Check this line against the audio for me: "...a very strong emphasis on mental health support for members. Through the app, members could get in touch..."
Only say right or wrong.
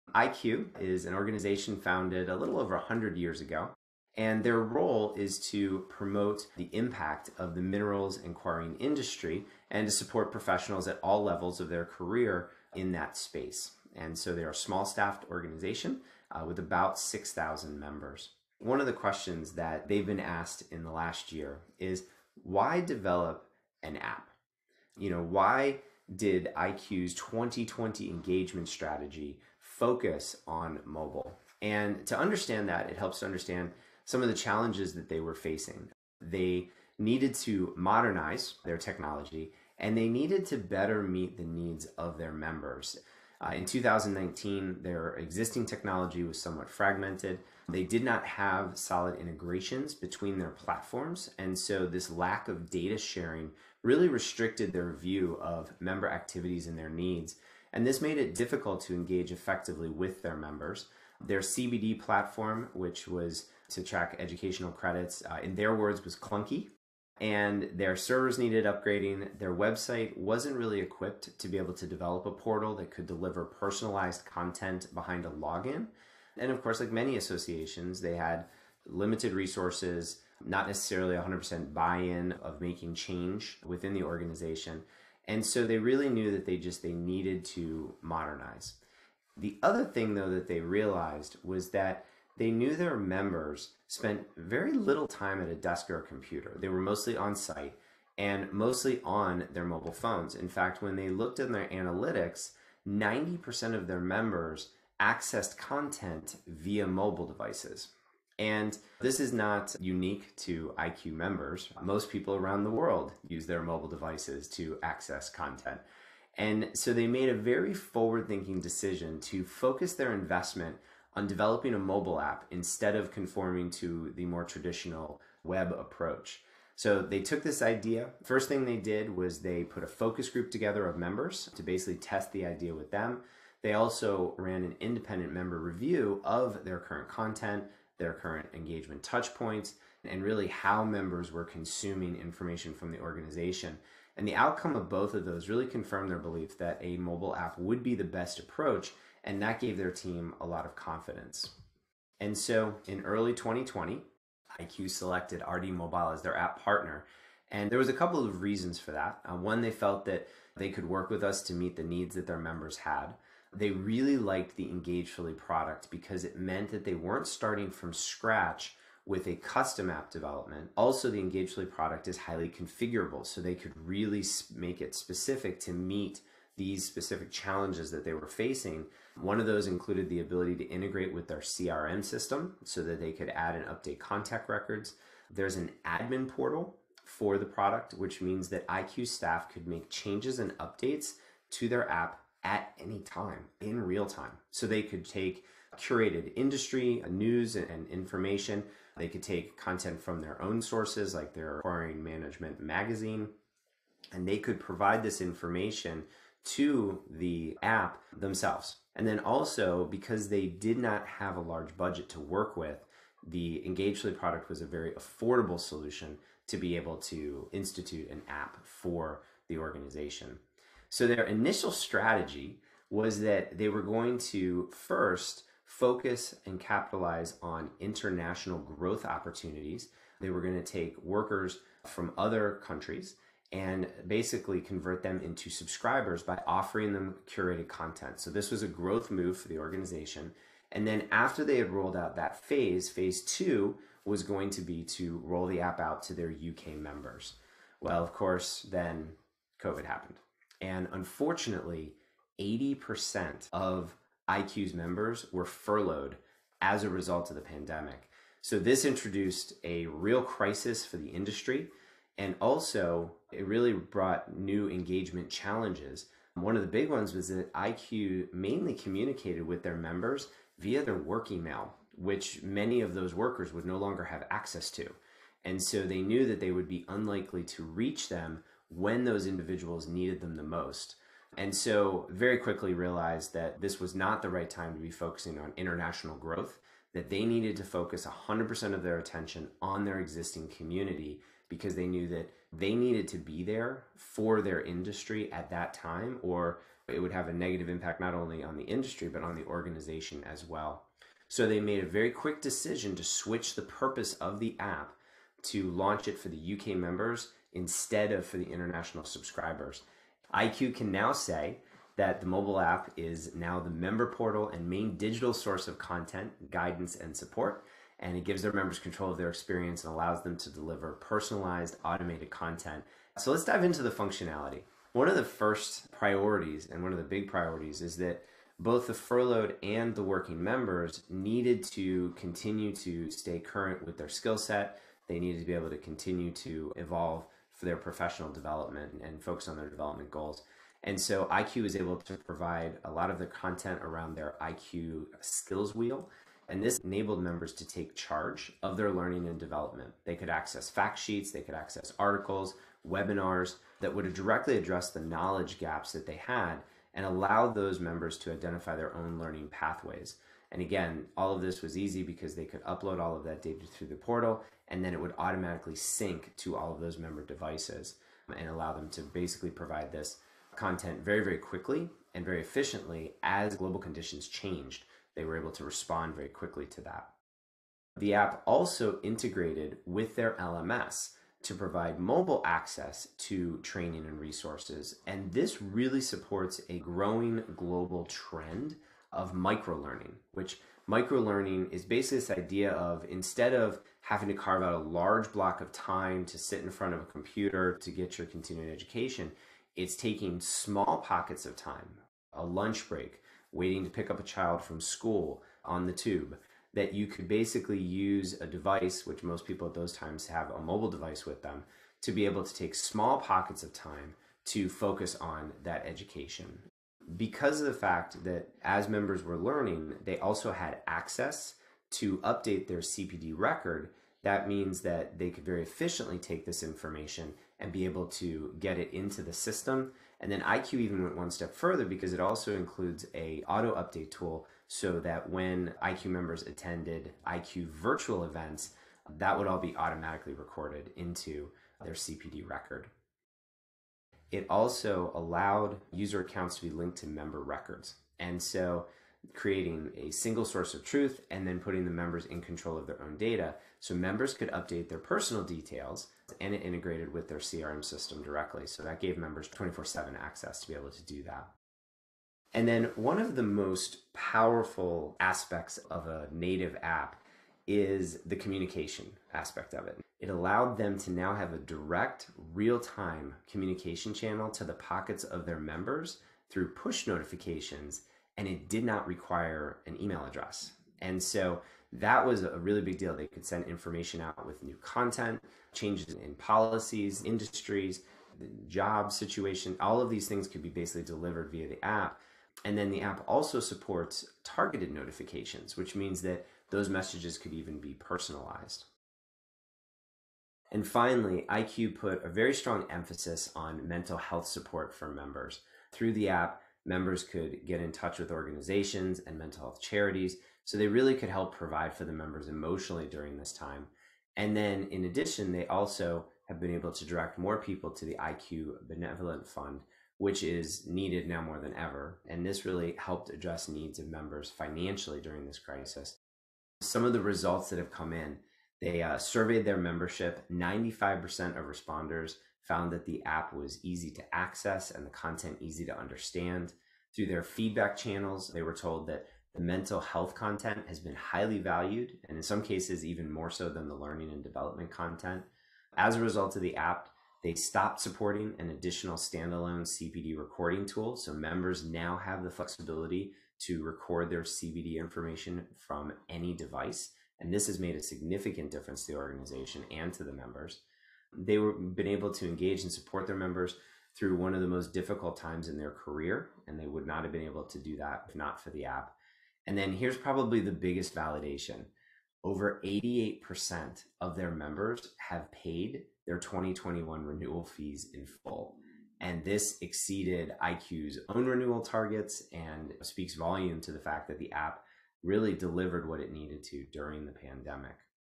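right.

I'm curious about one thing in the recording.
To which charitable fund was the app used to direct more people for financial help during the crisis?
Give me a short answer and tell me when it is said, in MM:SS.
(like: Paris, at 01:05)
IQ Benevolent Fund, at 08:38.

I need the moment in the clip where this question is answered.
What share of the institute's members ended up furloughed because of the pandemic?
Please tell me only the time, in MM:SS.
04:12.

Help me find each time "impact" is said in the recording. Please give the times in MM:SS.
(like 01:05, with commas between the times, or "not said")
00:06, 04:57.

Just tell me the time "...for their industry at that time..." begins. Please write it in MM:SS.
04:53.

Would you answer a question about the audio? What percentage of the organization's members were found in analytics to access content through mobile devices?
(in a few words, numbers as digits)
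90%.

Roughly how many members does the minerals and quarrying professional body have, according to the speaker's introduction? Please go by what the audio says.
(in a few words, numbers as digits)
6,000.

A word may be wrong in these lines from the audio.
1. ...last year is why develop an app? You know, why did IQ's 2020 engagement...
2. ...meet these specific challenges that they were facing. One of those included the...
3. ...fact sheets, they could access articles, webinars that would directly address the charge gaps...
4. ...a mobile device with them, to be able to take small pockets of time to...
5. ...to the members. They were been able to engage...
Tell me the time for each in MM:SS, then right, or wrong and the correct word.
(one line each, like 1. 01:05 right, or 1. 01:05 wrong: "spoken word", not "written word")
1. 00:20 right
2. 02:55 right
3. 05:50 wrong: "knowledge", not "charge"
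4. 06:50 right
5. 09:20 right.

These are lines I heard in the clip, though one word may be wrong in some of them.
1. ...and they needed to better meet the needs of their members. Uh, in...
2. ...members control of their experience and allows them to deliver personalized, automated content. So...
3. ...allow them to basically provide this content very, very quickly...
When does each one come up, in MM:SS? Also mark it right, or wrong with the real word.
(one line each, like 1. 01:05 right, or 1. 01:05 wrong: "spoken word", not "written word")
1. 00:39 right
2. 05:18 right
3. 06:08 right.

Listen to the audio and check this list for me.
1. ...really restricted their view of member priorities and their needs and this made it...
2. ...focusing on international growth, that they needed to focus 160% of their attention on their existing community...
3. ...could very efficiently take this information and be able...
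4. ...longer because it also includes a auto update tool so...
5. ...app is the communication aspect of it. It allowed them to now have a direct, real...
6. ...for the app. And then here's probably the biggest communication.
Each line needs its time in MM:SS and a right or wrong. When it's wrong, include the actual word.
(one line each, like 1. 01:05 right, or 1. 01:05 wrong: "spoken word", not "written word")
1. 00:53 wrong: "activities", not "priorities"
2. 04:44 wrong: "100", not "160"
3. 07:05 right
4. 07:11 wrong: "further", not "longer"
5. 07:46 right
6. 09:28 wrong: "validation", not "communication".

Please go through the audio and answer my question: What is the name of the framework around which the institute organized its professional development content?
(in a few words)
IQ skills wheel.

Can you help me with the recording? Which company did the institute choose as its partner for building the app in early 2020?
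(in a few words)
RD Mobile.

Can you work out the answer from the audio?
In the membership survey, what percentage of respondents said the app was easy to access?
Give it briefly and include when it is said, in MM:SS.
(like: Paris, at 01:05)
95%, at 08:50.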